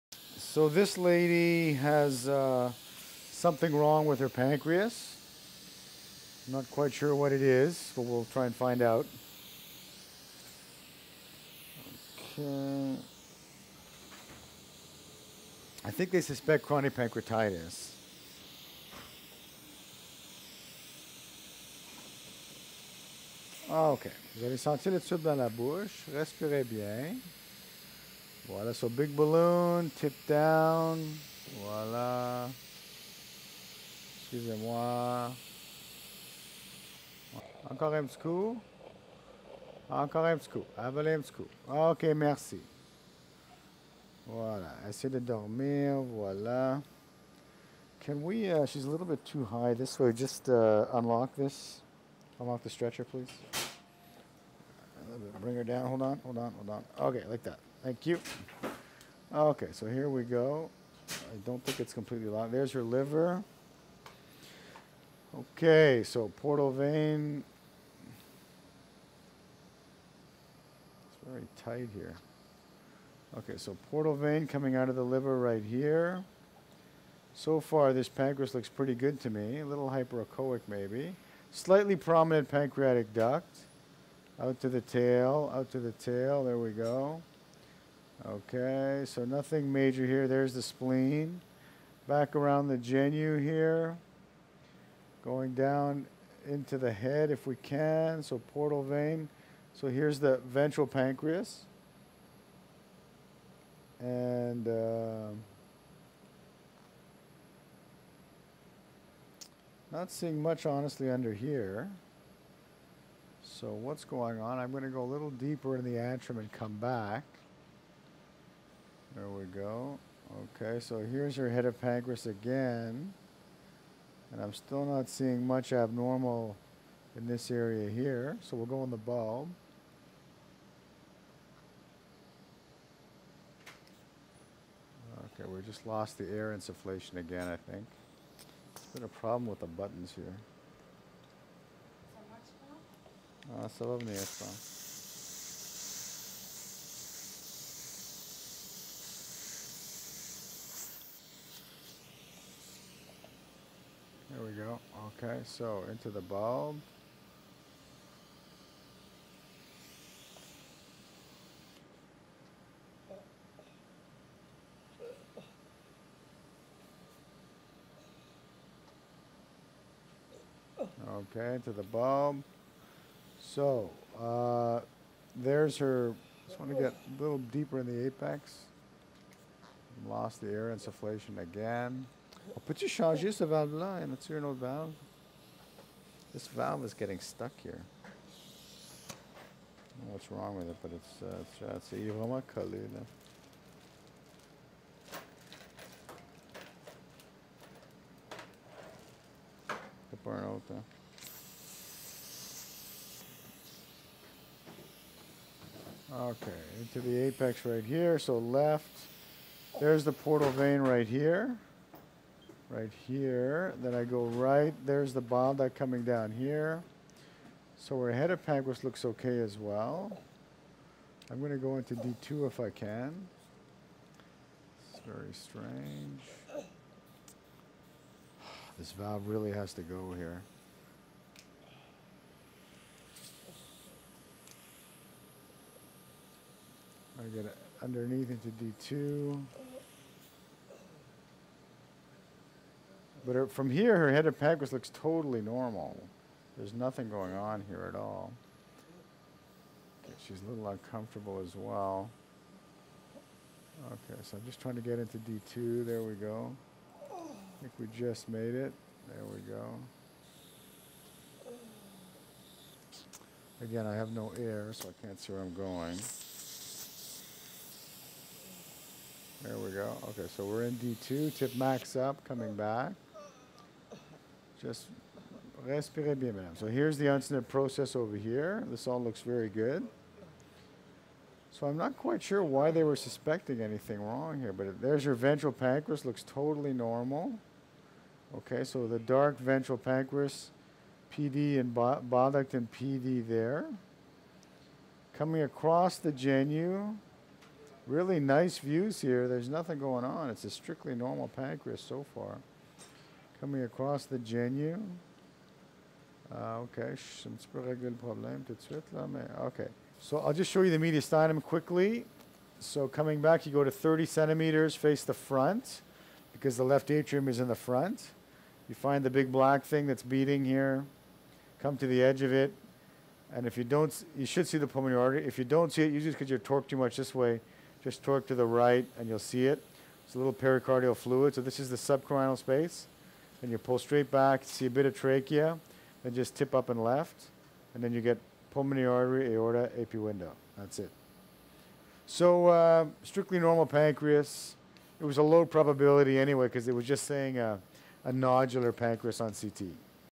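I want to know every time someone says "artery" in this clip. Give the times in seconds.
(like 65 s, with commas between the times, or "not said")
325 s, 338 s.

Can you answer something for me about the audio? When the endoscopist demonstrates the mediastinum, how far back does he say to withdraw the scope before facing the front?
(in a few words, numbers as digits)
30 centimeters.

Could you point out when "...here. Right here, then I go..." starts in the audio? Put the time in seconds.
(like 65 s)
211 s.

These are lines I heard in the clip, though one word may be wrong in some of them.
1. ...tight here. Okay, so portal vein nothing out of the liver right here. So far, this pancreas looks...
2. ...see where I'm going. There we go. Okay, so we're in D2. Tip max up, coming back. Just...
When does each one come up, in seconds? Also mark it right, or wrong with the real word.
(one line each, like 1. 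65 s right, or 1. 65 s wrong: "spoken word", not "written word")
1. 71 s wrong: "coming", not "nothing"
2. 265 s right.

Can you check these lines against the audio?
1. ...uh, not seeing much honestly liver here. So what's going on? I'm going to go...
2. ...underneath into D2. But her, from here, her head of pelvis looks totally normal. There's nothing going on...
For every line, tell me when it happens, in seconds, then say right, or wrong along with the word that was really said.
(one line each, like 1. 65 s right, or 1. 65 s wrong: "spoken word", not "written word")
1. 104 s wrong: "under", not "liver"
2. 237 s right.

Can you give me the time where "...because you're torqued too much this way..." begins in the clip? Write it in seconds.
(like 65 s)
326 s.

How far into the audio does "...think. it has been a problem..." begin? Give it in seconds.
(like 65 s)
137 s.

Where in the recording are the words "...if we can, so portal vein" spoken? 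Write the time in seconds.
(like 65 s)
97 s.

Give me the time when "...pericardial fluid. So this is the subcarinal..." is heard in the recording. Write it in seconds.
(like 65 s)
330 s.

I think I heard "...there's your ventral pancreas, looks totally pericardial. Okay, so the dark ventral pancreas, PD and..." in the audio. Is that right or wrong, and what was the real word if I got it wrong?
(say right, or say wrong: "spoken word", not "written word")
wrong: "normal", not "pericardial".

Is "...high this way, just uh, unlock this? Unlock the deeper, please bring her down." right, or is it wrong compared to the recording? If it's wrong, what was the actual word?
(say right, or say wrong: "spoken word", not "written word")
wrong: "stretcher", not "deeper".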